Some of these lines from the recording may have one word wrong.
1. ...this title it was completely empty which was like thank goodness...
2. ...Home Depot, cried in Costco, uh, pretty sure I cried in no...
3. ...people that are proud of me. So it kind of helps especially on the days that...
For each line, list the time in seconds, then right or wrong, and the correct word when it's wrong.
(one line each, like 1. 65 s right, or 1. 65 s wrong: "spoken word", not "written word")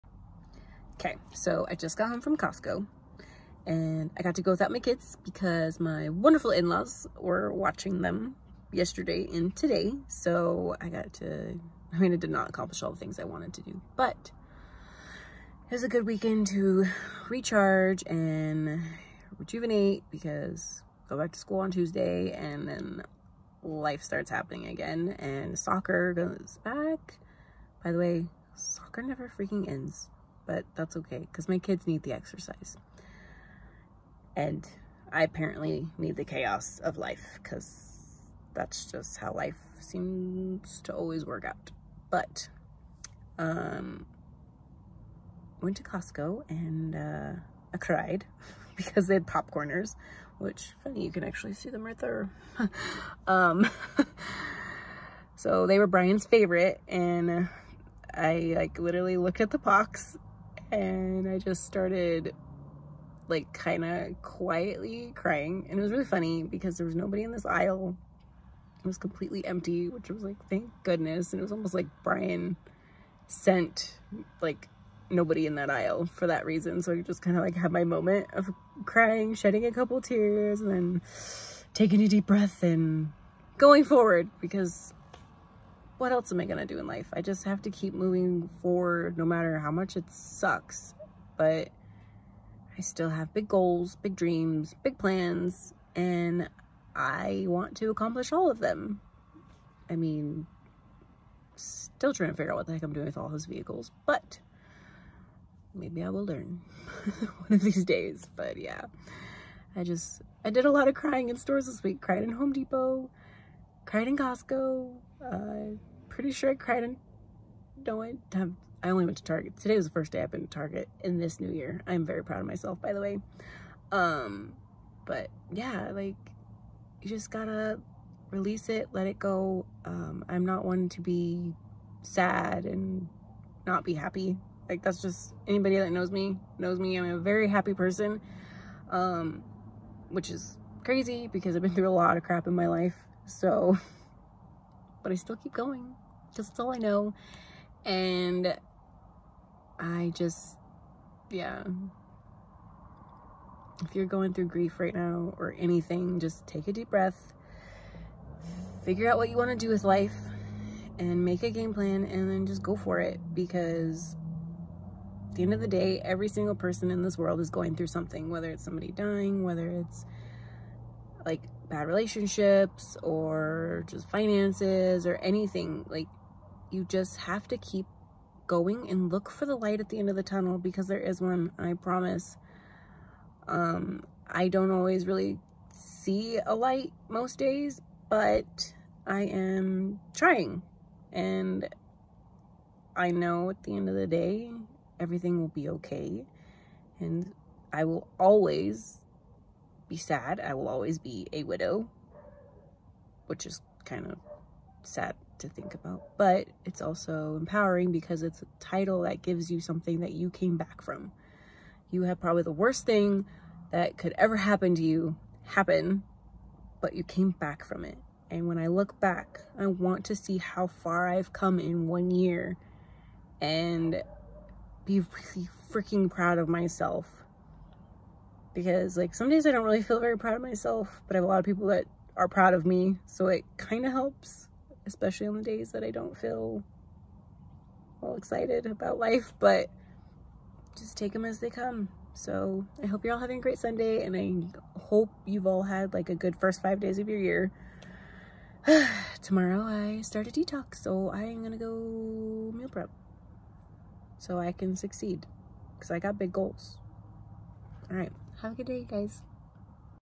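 1. 67 s wrong: "aisle", not "title"
2. 112 s right
3. 231 s right.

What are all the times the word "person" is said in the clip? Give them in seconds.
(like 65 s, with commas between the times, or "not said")
137 s, 166 s.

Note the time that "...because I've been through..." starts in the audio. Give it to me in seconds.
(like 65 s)
141 s.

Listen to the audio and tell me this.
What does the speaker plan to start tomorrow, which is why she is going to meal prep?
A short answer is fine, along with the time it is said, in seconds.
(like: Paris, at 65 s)
A detox, at 250 s.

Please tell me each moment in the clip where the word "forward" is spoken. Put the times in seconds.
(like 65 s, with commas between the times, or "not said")
83 s, 88 s.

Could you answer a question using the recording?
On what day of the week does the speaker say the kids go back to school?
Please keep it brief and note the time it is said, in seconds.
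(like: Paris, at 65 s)
Tuesday, at 21 s.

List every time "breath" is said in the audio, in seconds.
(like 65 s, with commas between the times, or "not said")
82 s, 156 s.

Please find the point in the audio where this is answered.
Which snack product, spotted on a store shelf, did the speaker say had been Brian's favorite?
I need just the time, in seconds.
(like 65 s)
49 s.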